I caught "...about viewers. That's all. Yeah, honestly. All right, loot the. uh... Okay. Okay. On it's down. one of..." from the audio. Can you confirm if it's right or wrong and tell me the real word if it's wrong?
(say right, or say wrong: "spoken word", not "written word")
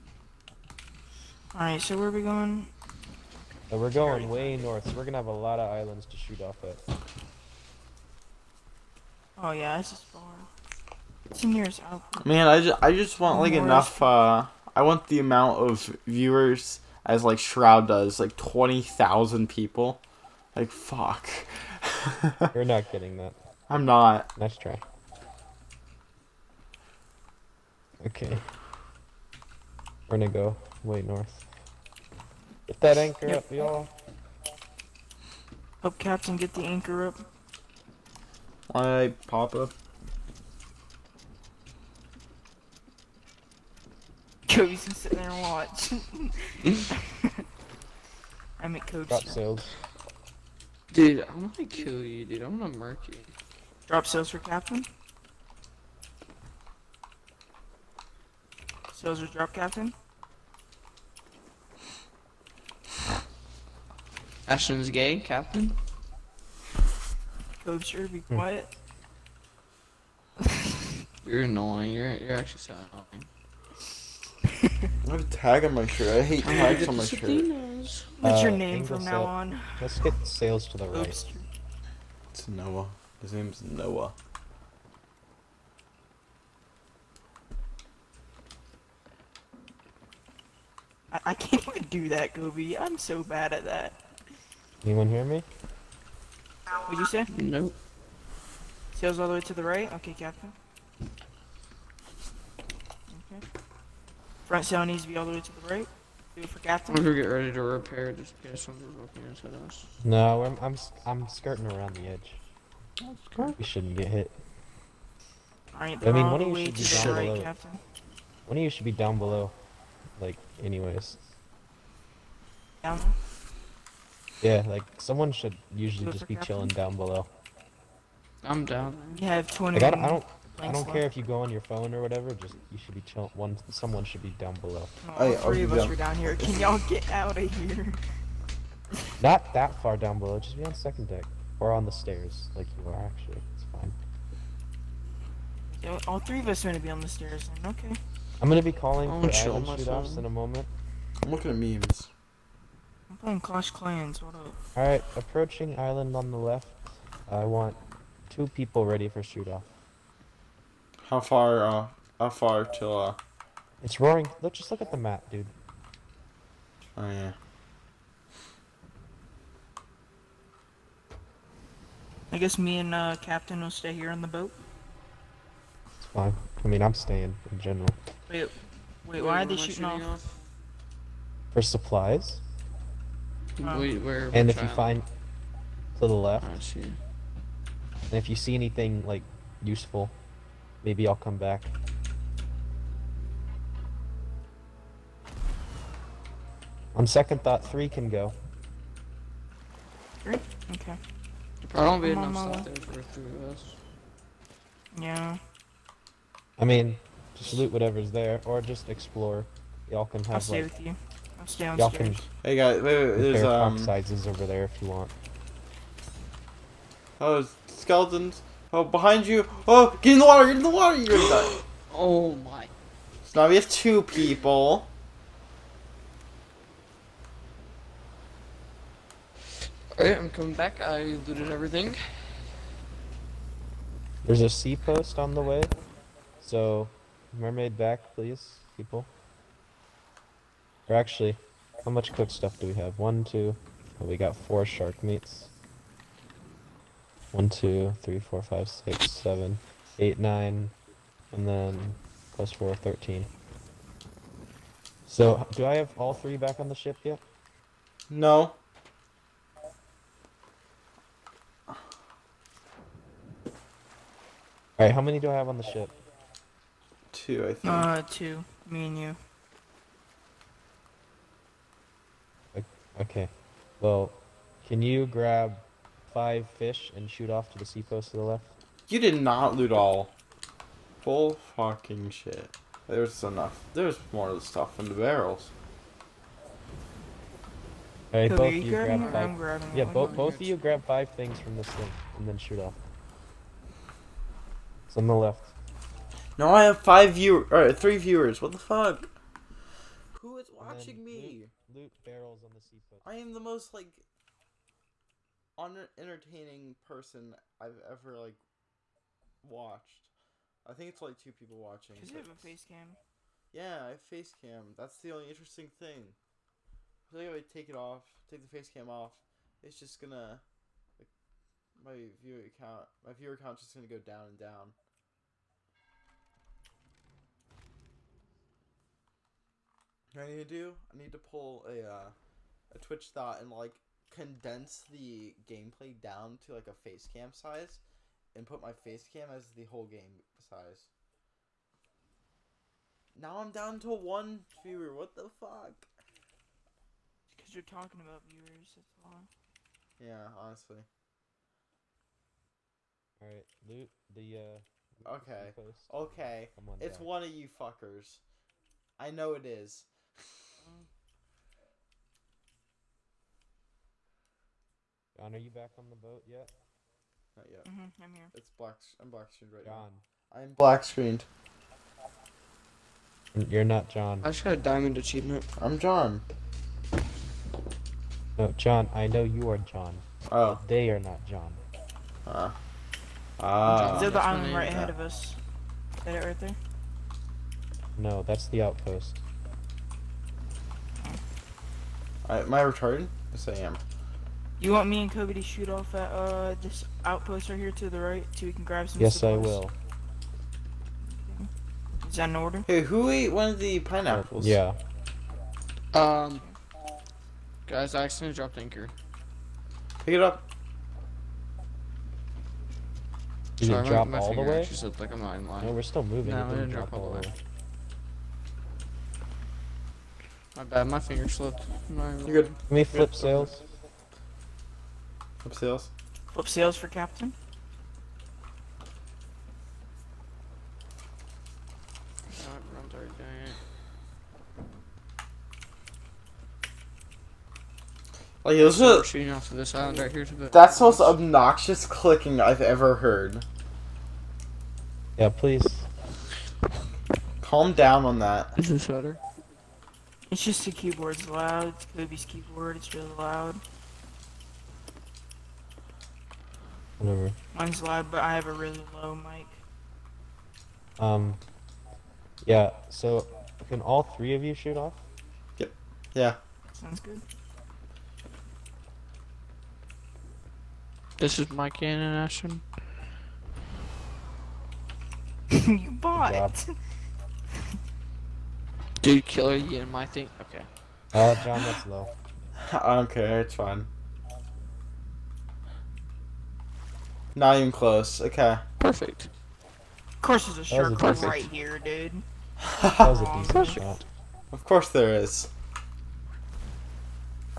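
right.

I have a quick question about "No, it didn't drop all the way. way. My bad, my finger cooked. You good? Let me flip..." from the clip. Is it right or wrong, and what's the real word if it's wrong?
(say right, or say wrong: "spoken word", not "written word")
wrong: "slipped", not "cooked".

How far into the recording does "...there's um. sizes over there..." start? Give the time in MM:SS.
03:33.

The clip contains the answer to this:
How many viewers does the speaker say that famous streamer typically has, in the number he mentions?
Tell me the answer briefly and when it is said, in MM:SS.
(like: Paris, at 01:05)
20,000, at 00:18.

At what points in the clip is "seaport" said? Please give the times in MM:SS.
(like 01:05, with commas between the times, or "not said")
05:02.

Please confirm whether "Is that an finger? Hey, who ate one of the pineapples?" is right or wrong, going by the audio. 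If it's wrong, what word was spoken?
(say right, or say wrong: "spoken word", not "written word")
wrong: "order", not "finger".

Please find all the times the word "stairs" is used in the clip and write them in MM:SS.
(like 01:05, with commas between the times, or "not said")
02:21, 02:27.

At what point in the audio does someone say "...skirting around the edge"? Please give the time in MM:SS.
01:51.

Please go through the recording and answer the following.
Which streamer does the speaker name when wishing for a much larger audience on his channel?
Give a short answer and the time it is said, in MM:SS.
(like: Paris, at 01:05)
Shroud, at 00:17.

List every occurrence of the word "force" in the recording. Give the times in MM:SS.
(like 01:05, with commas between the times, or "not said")
not said.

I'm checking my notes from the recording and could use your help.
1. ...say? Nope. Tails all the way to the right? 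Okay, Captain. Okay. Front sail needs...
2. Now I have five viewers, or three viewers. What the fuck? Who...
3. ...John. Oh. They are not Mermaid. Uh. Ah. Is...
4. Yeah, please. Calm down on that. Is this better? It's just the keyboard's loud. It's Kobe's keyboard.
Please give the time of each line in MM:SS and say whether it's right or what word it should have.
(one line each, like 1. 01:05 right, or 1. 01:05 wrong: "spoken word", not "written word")
1. 01:37 right
2. 04:56 right
3. 06:19 wrong: "John", not "Mermaid"
4. 07:25 right.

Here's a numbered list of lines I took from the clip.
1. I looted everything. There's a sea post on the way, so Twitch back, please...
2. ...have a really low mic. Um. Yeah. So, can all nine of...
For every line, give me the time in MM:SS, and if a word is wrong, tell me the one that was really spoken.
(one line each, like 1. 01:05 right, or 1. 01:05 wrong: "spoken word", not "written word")
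1. 03:50 wrong: "Mermaid", not "Twitch"
2. 07:38 wrong: "three", not "nine".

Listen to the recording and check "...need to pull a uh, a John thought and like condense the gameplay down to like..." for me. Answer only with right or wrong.
wrong.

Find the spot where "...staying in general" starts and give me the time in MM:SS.
02:56.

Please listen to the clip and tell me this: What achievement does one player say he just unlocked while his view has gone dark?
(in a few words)
Diamond achievement.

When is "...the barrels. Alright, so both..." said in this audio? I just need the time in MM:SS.
04:44.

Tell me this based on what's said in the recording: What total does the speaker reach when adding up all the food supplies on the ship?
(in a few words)
13.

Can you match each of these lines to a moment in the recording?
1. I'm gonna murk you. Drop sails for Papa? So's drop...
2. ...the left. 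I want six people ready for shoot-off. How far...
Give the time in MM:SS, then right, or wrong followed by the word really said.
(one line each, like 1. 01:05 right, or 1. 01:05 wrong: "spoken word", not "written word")
1. 00:52 wrong: "Captain", not "Papa"
2. 02:36 wrong: "two", not "six".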